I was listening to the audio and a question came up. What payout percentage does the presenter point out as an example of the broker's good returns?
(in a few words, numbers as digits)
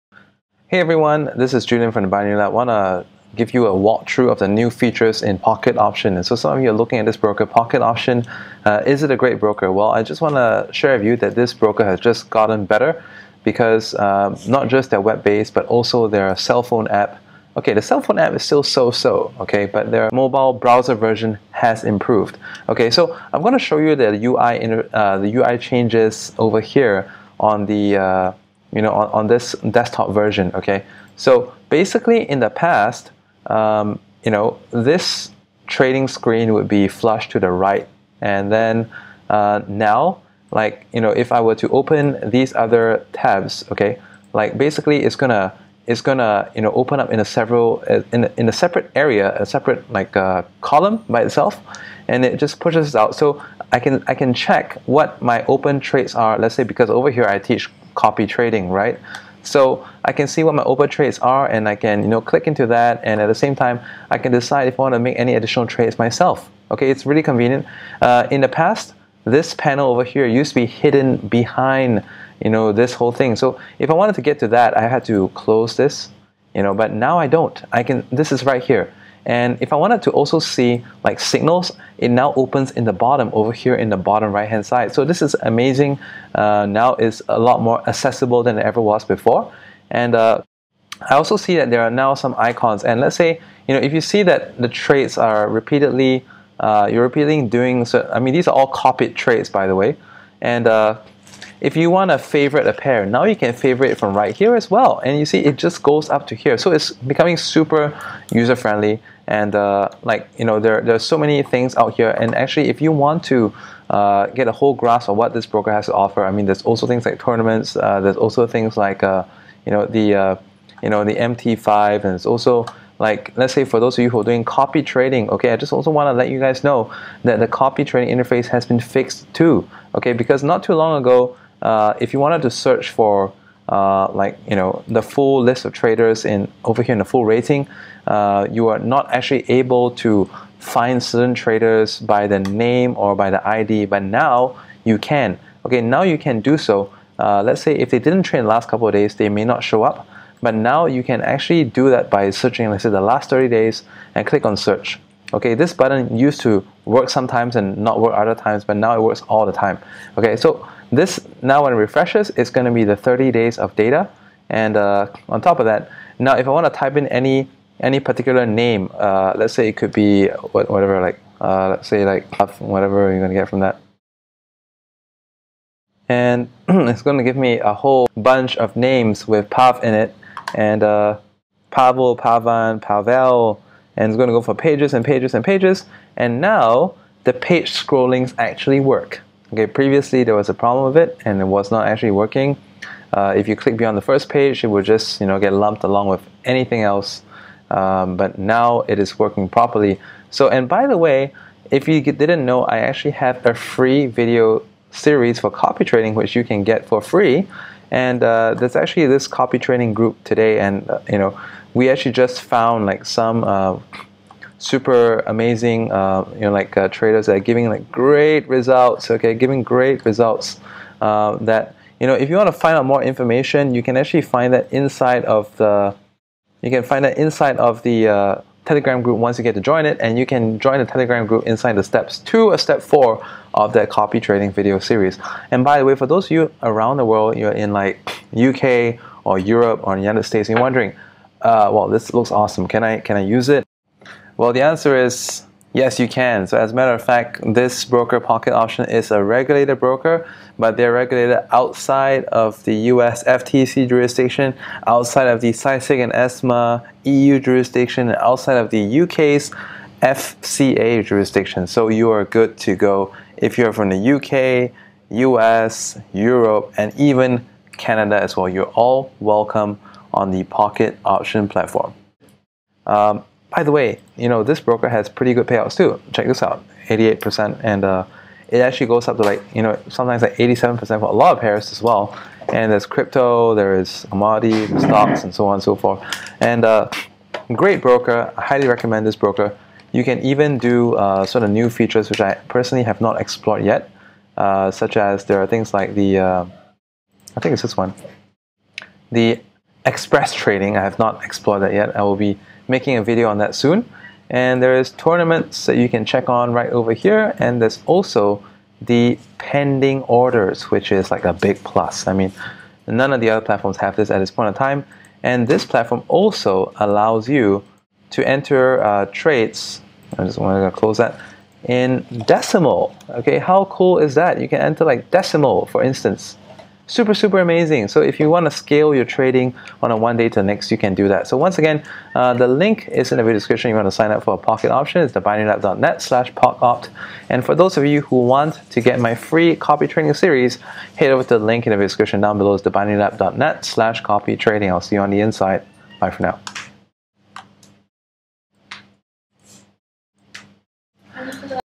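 88%.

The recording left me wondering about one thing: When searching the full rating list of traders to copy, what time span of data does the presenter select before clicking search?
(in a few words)
30 days.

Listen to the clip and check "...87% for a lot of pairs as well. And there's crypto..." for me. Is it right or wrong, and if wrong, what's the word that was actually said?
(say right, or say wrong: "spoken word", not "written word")
right.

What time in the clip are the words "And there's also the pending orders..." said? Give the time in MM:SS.
05:07.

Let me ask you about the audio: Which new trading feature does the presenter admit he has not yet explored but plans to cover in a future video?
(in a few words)
express trading.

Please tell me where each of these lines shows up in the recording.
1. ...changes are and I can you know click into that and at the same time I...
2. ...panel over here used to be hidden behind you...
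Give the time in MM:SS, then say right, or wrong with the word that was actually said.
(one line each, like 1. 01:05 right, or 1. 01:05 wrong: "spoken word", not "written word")
1. 01:00 wrong: "trades", not "changes"
2. 01:09 right.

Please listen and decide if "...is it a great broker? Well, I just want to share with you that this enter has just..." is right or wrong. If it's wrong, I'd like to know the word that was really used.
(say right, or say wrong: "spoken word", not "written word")
wrong: "broker", not "enter".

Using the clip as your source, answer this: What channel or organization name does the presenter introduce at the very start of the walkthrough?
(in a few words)
Binary Lab.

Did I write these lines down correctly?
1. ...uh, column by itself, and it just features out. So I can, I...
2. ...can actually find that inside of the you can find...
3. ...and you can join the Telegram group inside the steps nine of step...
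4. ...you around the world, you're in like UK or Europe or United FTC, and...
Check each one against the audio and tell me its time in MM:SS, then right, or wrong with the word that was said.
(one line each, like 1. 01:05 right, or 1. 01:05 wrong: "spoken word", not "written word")
1. 00:50 wrong: "pushes", not "features"
2. 03:43 right
3. 03:50 wrong: "two", not "nine"
4. 03:56 wrong: "States", not "FTC".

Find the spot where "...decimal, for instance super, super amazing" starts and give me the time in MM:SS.
05:25.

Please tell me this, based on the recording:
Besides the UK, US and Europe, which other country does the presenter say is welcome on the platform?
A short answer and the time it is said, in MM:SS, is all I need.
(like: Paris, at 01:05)
Canada, at 04:27.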